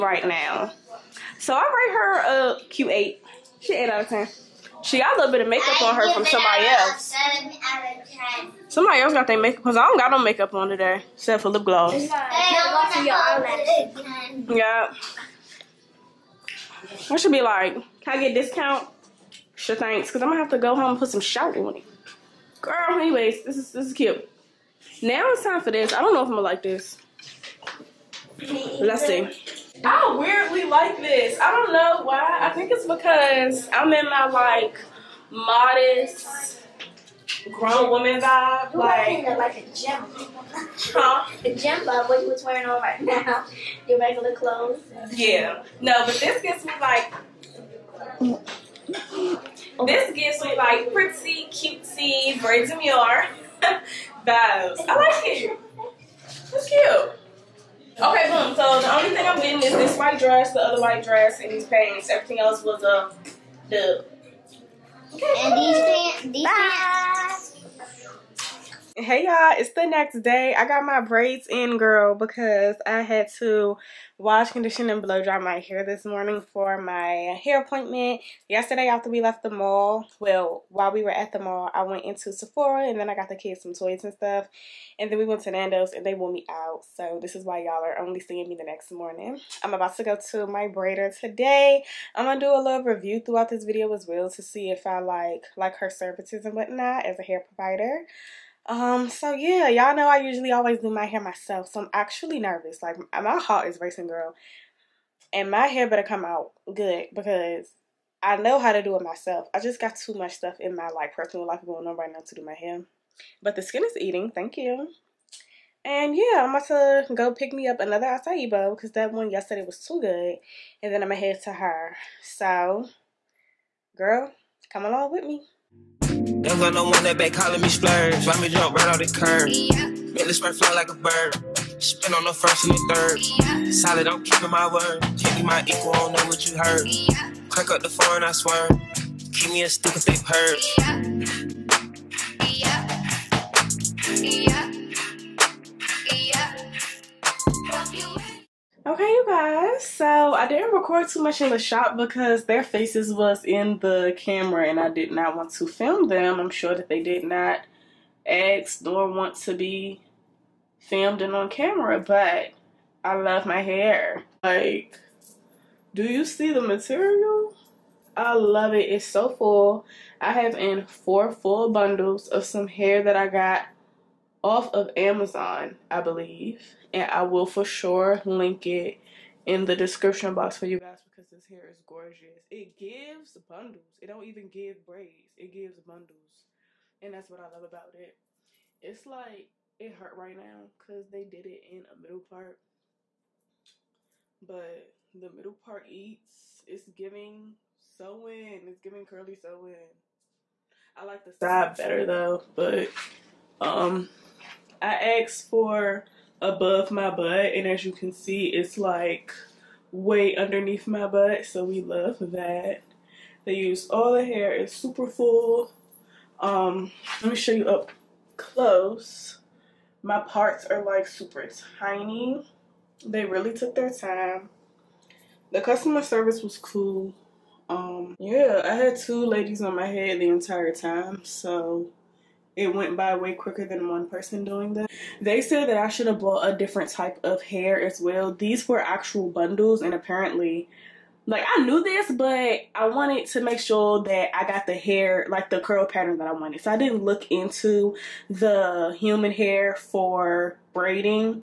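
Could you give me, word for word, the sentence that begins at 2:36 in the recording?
I'm sure that they did not ask nor want to be filmed and on camera, but I love my hair.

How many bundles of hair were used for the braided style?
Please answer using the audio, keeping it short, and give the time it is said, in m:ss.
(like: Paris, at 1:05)
4, at 2:50.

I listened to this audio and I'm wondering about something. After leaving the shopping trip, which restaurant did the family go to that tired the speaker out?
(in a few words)
Nando's.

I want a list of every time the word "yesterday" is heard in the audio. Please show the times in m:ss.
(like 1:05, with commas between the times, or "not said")
1:18, 1:59.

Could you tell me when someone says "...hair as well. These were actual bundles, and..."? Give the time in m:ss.
3:57.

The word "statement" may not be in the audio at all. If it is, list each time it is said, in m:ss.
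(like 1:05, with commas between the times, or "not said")
not said.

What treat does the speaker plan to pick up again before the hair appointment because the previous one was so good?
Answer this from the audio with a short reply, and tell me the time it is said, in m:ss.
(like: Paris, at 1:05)
acai bowl, at 1:58.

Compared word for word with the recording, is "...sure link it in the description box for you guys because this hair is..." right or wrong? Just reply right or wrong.
right.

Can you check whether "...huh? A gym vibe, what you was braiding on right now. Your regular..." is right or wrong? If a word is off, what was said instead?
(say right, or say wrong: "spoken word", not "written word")
wrong: "wearing", not "braiding".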